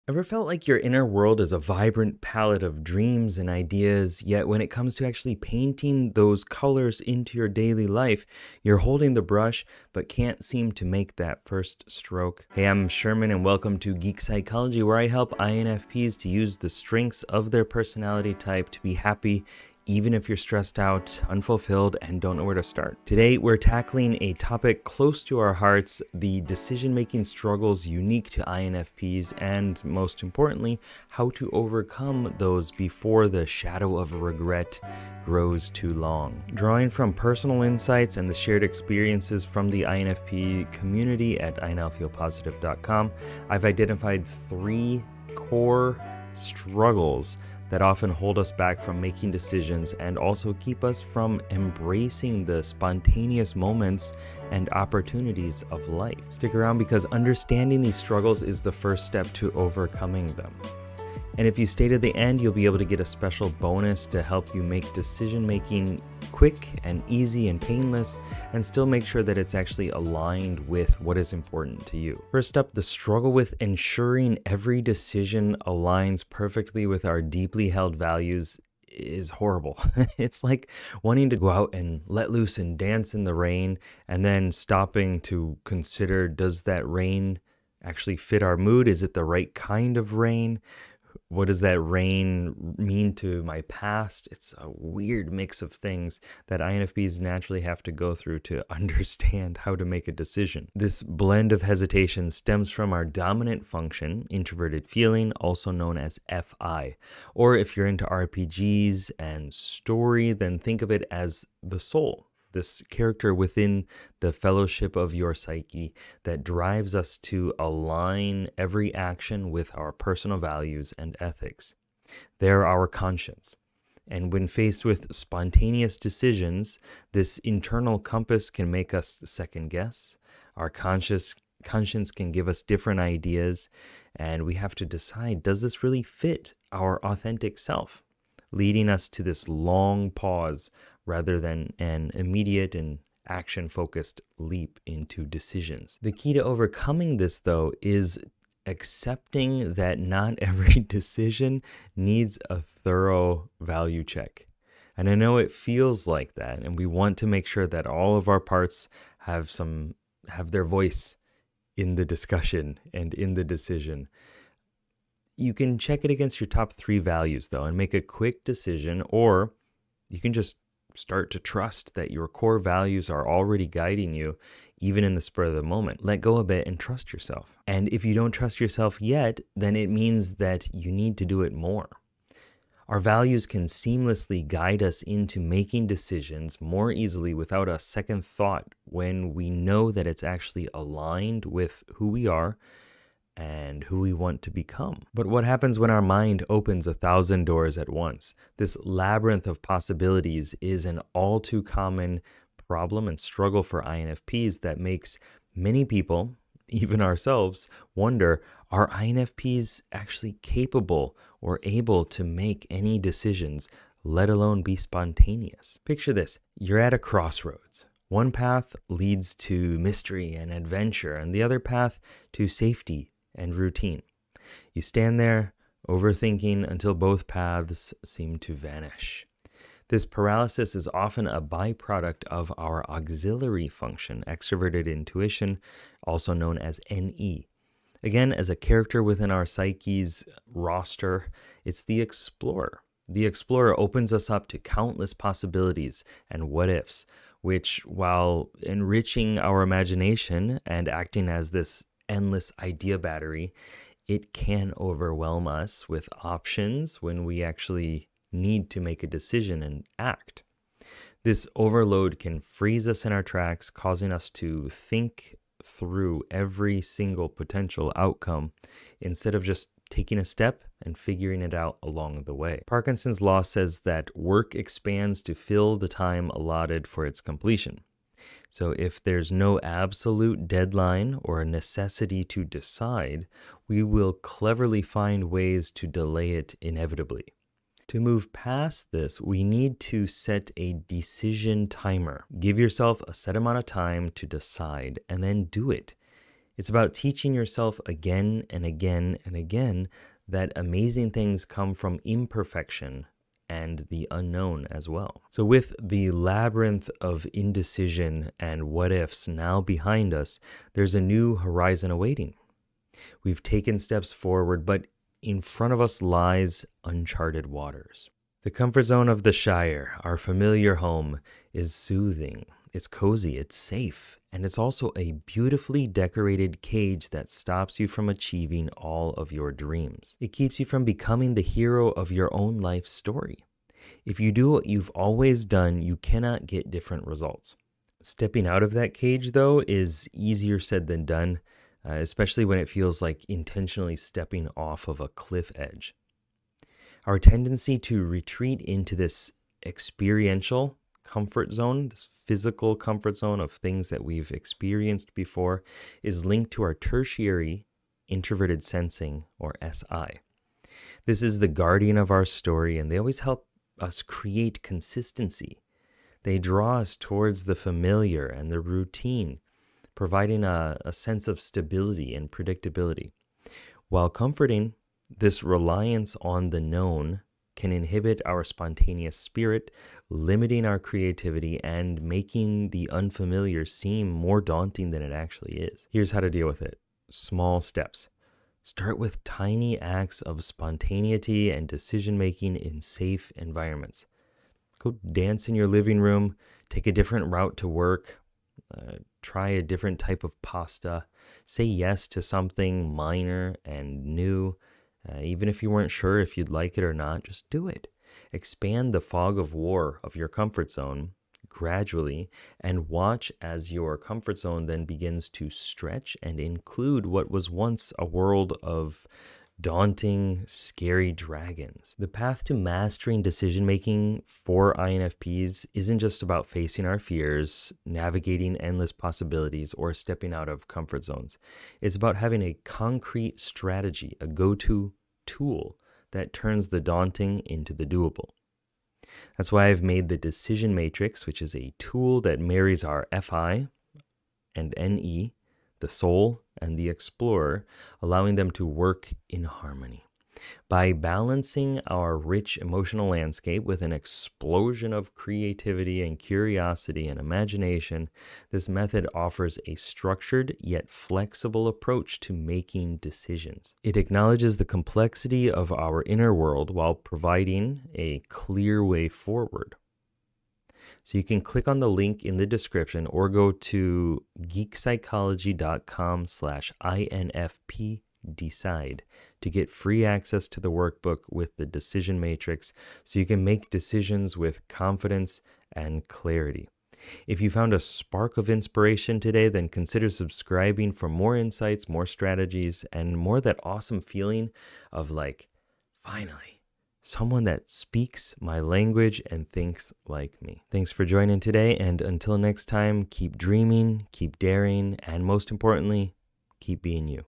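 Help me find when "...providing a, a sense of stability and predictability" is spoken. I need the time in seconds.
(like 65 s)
369 s.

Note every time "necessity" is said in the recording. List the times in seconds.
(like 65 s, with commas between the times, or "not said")
281 s.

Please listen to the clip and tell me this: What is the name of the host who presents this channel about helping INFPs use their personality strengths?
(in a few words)
Sherman.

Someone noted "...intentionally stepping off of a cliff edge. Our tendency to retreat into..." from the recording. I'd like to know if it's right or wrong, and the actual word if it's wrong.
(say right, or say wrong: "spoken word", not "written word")
right.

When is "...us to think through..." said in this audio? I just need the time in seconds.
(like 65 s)
264 s.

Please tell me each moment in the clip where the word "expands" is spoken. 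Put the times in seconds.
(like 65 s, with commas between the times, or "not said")
274 s, 408 s.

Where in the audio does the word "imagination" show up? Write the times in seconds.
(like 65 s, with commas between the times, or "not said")
249 s, 457 s.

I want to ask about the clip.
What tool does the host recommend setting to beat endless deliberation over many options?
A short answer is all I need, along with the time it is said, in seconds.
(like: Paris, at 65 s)
a decision timer, at 290 s.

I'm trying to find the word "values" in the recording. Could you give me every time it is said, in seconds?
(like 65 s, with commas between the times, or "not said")
77 s, 120 s, 153 s, 166 s, 172 s, 182 s.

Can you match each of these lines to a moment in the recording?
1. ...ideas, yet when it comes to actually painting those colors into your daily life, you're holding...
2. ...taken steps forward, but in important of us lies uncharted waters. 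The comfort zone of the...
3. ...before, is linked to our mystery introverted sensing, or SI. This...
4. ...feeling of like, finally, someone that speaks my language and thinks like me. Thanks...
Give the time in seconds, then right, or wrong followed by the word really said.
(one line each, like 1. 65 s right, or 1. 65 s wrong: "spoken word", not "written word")
1. 3 s right
2. 313 s wrong: "front", not "important"
3. 355 s wrong: "tertiary", not "mystery"
4. 494 s right.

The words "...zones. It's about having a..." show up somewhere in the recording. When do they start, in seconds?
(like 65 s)
431 s.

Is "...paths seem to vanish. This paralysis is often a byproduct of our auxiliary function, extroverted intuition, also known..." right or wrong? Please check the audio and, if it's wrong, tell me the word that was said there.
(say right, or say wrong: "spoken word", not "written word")
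right.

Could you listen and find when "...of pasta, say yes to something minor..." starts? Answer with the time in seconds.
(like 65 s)
400 s.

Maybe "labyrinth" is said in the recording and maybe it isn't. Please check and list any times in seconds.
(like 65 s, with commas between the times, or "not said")
198 s, 306 s.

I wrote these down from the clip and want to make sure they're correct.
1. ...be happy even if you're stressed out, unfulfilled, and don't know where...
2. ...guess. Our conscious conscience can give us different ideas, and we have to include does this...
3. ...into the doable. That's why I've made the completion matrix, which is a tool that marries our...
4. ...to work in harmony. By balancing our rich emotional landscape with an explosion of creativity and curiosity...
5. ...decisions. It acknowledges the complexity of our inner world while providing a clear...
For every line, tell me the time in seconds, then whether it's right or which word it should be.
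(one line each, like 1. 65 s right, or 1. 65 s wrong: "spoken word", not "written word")
1. 18 s right
2. 129 s wrong: "decide", not "include"
3. 437 s wrong: "decision", not "completion"
4. 448 s right
5. 462 s right.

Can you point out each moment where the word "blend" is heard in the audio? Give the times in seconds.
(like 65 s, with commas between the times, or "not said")
101 s.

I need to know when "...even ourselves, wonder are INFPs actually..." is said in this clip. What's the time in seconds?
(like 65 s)
206 s.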